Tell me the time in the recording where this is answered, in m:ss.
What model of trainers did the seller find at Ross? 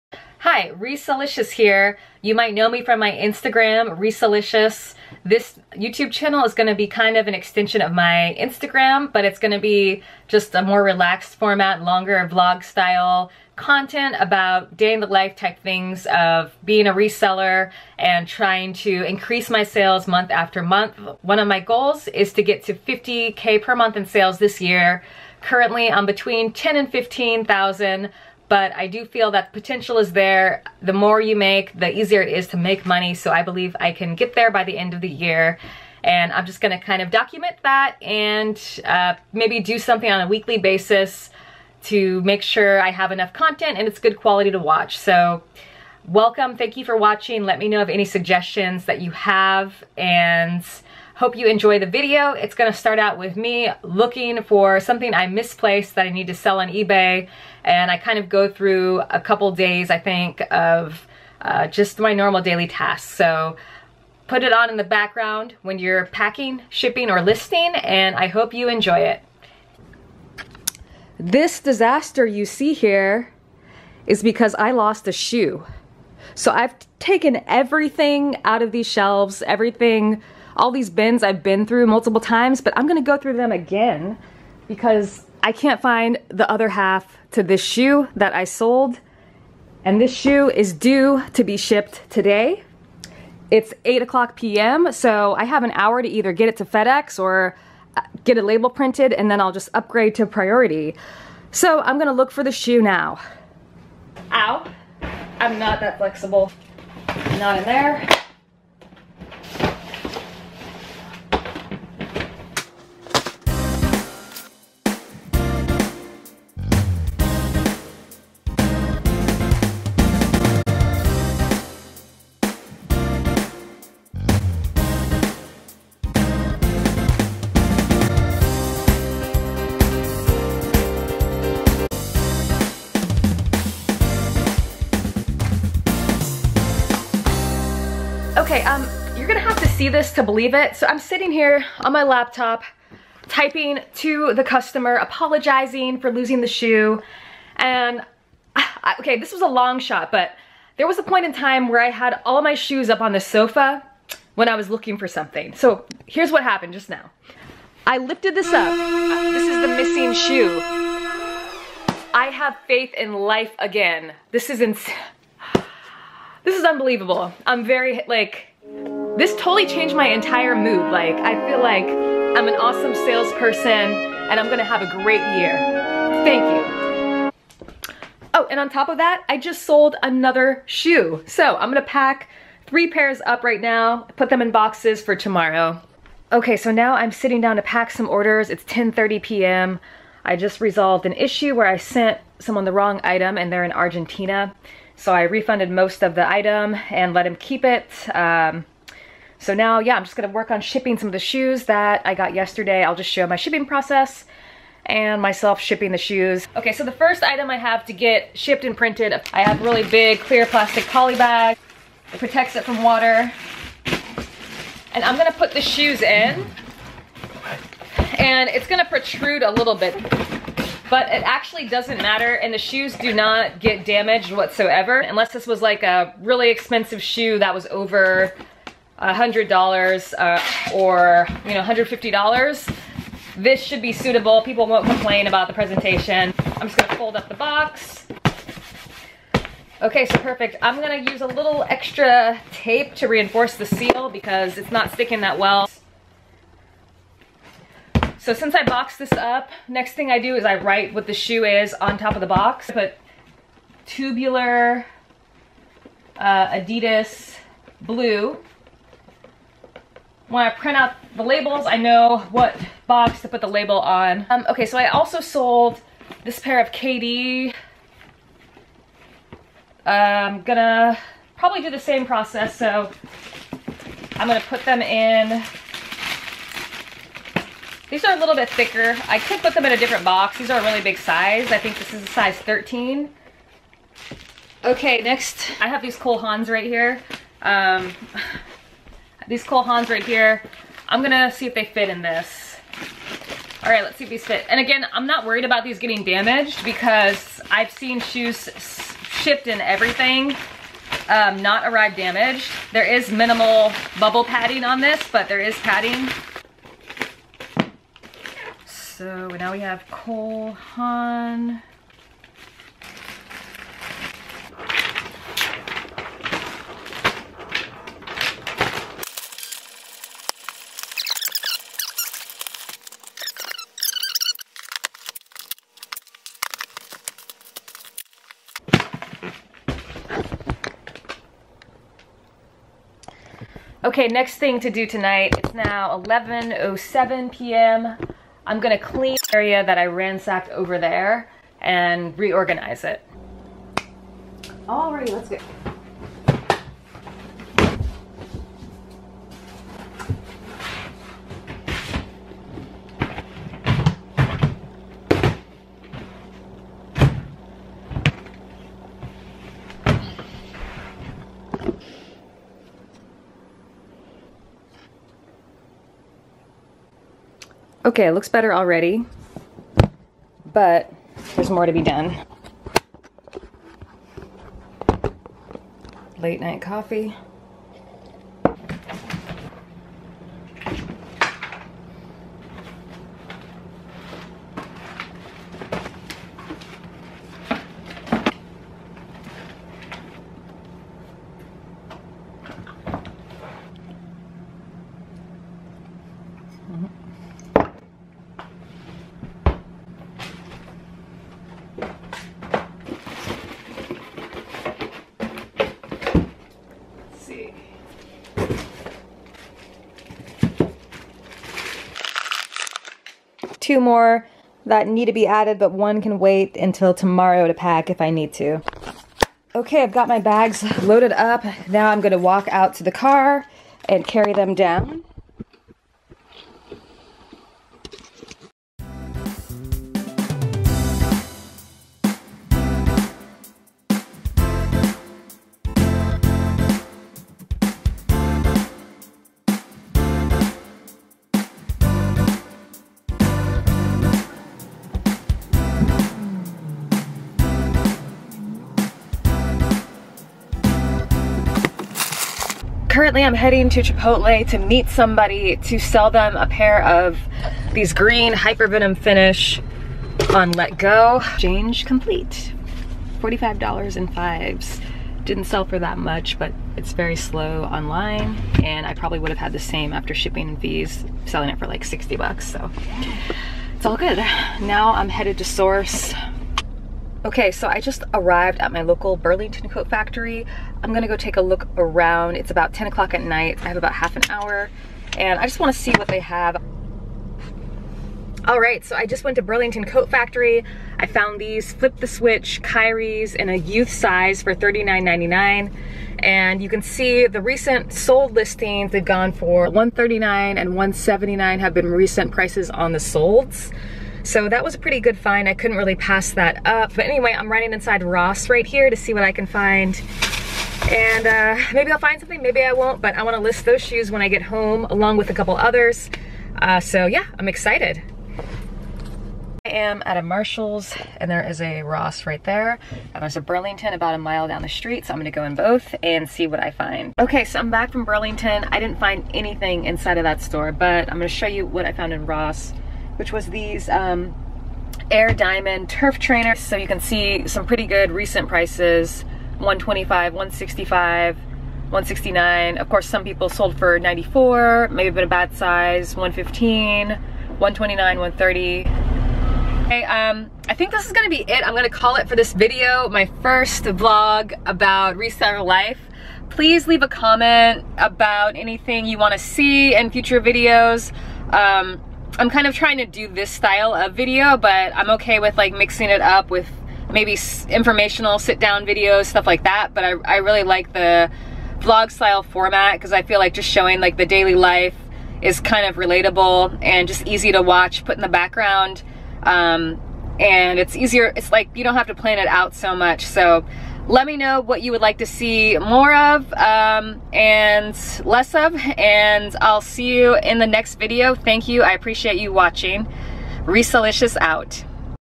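8:55.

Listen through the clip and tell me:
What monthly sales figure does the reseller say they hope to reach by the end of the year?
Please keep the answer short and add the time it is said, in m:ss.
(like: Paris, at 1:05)
50K, at 0:22.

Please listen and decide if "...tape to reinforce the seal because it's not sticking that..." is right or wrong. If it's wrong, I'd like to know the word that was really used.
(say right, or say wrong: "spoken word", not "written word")
right.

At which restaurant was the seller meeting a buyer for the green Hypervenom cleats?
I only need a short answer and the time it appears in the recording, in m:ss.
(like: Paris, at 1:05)
Chipotle, at 7:33.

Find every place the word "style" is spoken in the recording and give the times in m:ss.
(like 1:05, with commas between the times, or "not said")
0:12, 9:23, 9:32.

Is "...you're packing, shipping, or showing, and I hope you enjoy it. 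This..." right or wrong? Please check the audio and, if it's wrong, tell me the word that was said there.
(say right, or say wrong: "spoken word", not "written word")
wrong: "listing", not "showing".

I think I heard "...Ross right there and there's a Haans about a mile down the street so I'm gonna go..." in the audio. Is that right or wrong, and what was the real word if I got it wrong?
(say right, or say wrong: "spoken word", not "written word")
wrong: "Burlington", not "Haans".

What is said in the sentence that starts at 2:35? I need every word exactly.
So here's what happened just now.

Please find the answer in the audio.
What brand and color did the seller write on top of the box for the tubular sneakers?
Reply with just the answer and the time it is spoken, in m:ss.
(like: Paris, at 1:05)
Adidas blue, at 4:16.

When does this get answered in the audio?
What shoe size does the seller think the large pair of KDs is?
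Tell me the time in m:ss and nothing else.
4:42.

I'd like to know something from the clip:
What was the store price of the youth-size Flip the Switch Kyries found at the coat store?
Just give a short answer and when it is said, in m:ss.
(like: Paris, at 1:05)
$39.99, at 8:14.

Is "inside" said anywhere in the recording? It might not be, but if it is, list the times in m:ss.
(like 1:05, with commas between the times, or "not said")
8:27, 8:49.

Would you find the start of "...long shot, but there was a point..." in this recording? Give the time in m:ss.
2:29.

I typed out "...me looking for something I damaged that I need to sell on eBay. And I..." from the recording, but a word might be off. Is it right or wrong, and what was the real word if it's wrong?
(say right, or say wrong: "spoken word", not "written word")
wrong: "misplaced", not "damaged".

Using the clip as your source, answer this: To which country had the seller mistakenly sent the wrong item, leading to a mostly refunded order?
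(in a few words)
Argentina.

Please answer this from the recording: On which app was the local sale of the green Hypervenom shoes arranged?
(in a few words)
Letgo.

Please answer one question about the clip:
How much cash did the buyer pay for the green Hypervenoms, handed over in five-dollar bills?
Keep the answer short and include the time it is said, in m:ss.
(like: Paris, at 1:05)
$45, at 7:43.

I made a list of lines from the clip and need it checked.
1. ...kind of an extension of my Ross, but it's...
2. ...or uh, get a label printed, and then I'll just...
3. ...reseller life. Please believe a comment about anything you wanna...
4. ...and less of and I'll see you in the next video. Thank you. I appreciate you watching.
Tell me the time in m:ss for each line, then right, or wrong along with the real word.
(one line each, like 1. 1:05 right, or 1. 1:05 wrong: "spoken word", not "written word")
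1. 0:06 wrong: "Instagram", not "Ross"
2. 1:37 right
3. 9:15 wrong: "leave", not "believe"
4. 9:47 right.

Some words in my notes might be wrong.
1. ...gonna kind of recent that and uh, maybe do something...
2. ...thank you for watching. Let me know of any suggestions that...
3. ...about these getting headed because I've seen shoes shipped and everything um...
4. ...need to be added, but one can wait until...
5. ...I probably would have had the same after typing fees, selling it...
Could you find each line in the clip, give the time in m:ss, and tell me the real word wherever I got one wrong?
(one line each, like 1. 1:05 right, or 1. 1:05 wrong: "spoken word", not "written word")
1. 0:36 wrong: "document", not "recent"
2. 0:46 right
3. 4:55 wrong: "damaged", not "headed"
4. 6:54 right
5. 7:48 wrong: "shipping", not "typing".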